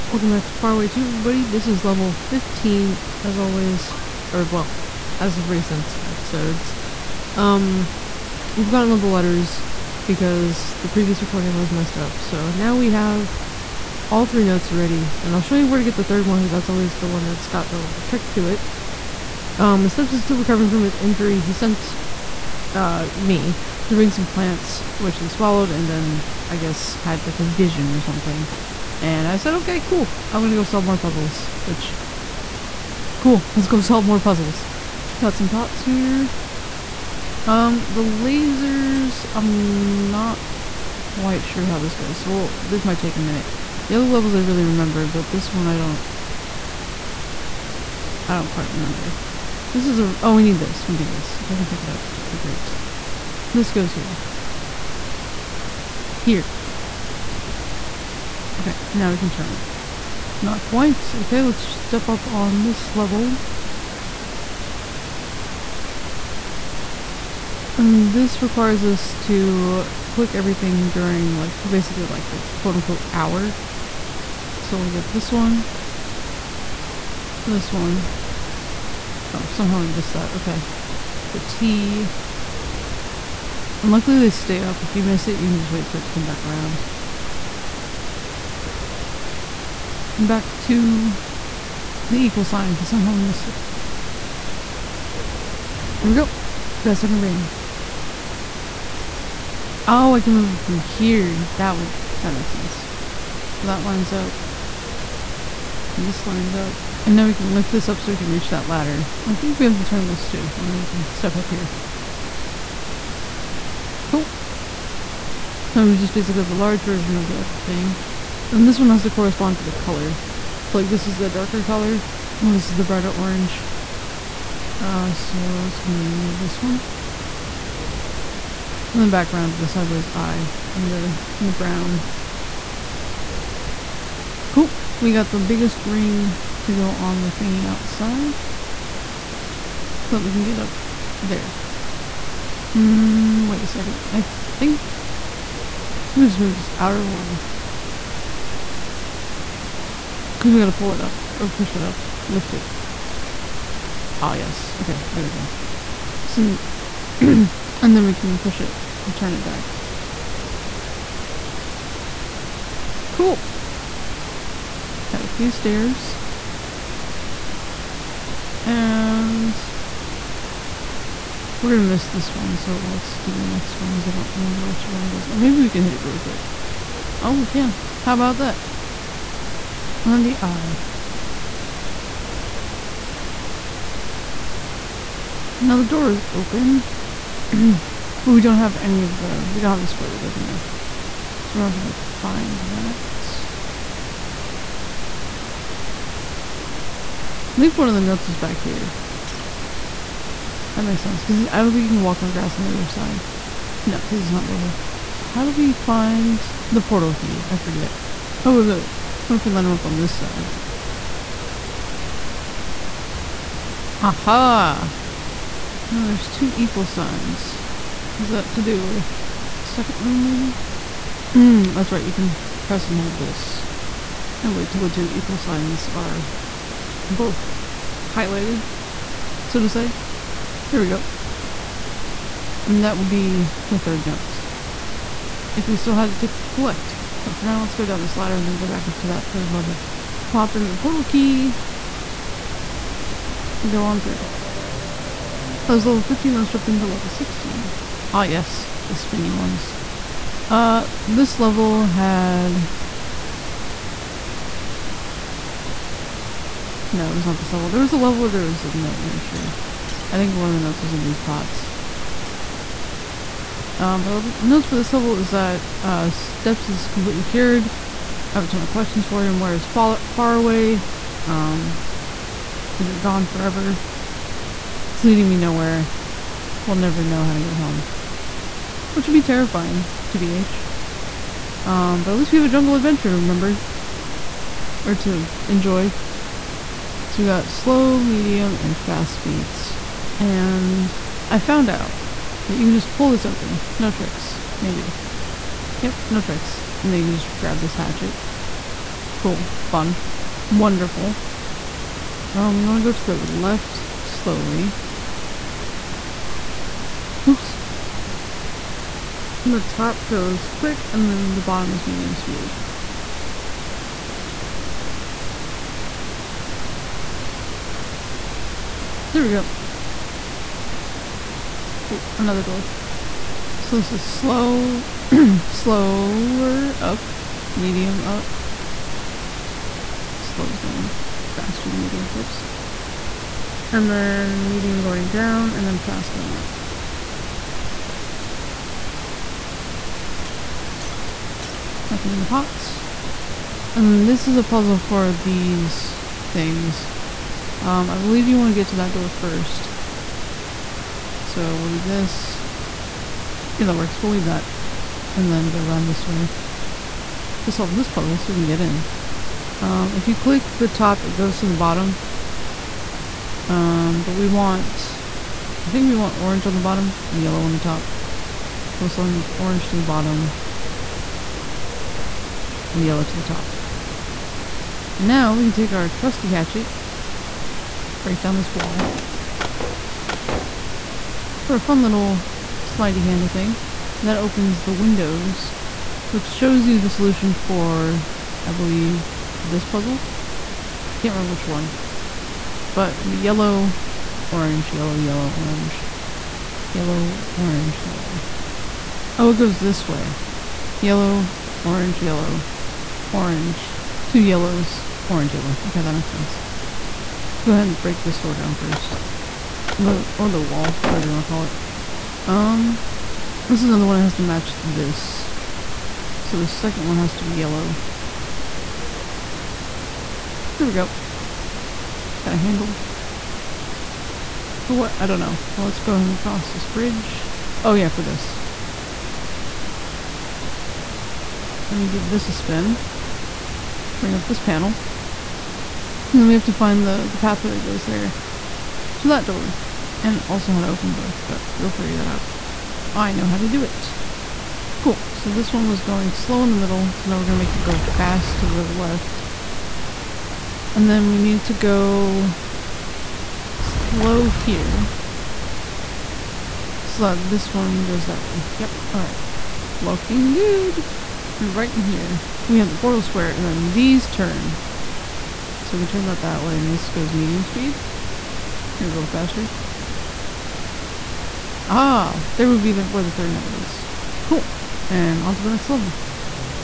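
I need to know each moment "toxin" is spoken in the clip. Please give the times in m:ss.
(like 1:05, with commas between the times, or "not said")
not said.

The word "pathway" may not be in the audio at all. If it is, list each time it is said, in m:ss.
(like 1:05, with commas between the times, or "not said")
7:17.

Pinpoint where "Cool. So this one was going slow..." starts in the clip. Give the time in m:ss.
7:24.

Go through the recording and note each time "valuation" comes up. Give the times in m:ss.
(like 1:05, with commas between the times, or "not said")
not said.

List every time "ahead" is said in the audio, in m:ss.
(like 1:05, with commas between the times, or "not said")
6:47, 7:05.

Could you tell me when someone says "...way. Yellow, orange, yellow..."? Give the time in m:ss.
6:39.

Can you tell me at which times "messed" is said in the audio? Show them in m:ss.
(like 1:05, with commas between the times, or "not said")
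0:11.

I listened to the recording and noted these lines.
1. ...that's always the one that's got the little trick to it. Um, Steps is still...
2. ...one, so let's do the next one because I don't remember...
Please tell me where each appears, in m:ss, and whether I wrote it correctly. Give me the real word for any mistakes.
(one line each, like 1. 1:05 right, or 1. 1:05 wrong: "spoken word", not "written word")
1. 0:16 wrong: "Snips", not "Steps"
2. 2:52 right.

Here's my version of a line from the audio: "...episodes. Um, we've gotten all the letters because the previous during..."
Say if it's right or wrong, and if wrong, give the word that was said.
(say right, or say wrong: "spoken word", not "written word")
wrong: "recording", not "during".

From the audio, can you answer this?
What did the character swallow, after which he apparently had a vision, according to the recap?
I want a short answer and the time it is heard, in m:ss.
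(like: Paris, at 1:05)
plants, at 0:24.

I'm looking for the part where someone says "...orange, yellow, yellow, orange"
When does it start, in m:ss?
6:34.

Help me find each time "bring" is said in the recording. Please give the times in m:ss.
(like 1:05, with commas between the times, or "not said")
0:23, 7:13.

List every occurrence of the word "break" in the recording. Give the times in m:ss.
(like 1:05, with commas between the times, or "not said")
6:18, 6:47.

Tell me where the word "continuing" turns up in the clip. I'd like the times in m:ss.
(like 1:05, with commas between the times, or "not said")
not said.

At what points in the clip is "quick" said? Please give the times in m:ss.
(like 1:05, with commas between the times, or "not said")
2:56, 5:10.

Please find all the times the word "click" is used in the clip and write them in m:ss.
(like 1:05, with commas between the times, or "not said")
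1:10, 6:00.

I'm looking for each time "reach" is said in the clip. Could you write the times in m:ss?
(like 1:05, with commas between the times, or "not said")
1:48.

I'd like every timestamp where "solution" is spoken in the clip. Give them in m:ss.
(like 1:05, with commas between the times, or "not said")
6:26.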